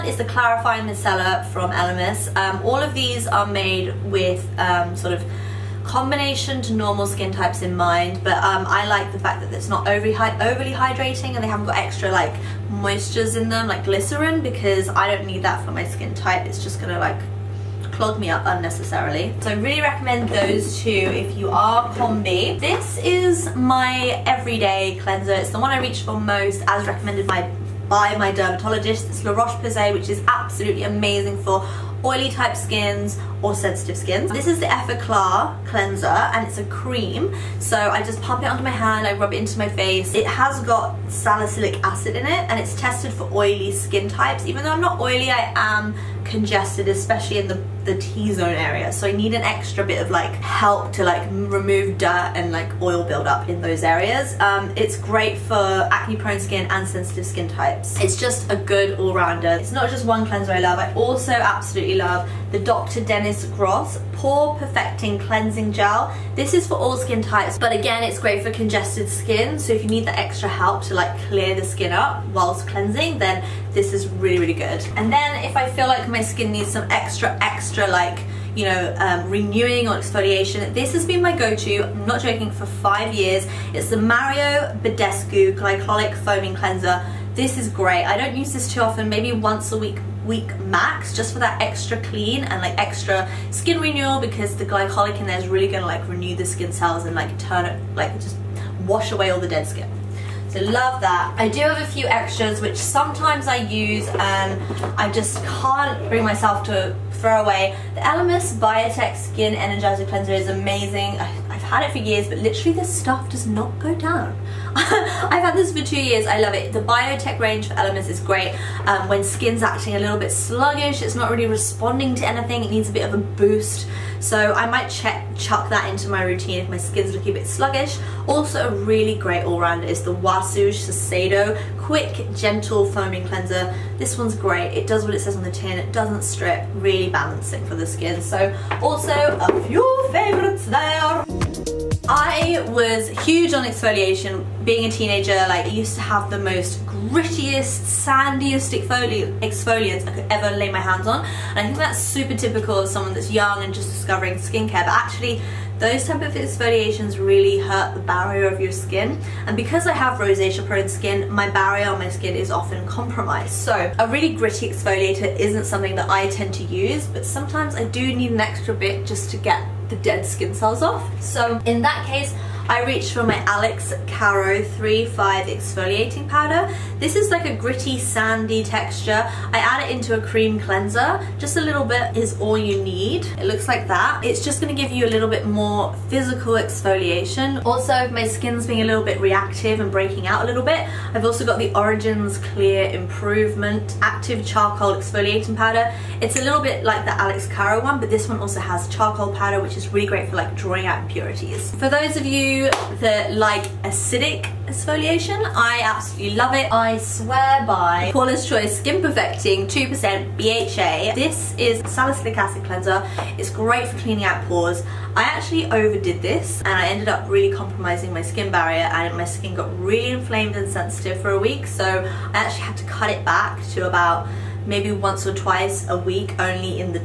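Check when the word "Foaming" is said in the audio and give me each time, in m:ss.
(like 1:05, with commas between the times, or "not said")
1:26, 2:12.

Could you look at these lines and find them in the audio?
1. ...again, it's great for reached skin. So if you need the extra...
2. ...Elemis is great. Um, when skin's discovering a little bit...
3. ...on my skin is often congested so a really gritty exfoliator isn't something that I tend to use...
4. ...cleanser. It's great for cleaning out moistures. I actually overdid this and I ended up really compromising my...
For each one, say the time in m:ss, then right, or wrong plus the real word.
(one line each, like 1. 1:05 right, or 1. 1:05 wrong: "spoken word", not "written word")
1. 1:07 wrong: "congested", not "reached"
2. 1:57 wrong: "acting", not "discovering"
3. 2:41 wrong: "compromised", not "congested"
4. 3:32 wrong: "pores", not "moistures".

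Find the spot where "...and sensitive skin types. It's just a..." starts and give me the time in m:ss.
0:56.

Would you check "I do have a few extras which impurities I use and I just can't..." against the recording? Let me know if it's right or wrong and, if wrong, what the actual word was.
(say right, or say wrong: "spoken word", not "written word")
wrong: "sometimes", not "impurities".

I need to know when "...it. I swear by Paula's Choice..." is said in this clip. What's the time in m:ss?
3:26.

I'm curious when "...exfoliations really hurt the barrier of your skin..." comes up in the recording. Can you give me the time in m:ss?
2:36.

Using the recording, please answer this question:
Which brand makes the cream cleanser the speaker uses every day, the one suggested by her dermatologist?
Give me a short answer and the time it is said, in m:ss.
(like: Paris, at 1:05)
La Roche-Posay, at 0:29.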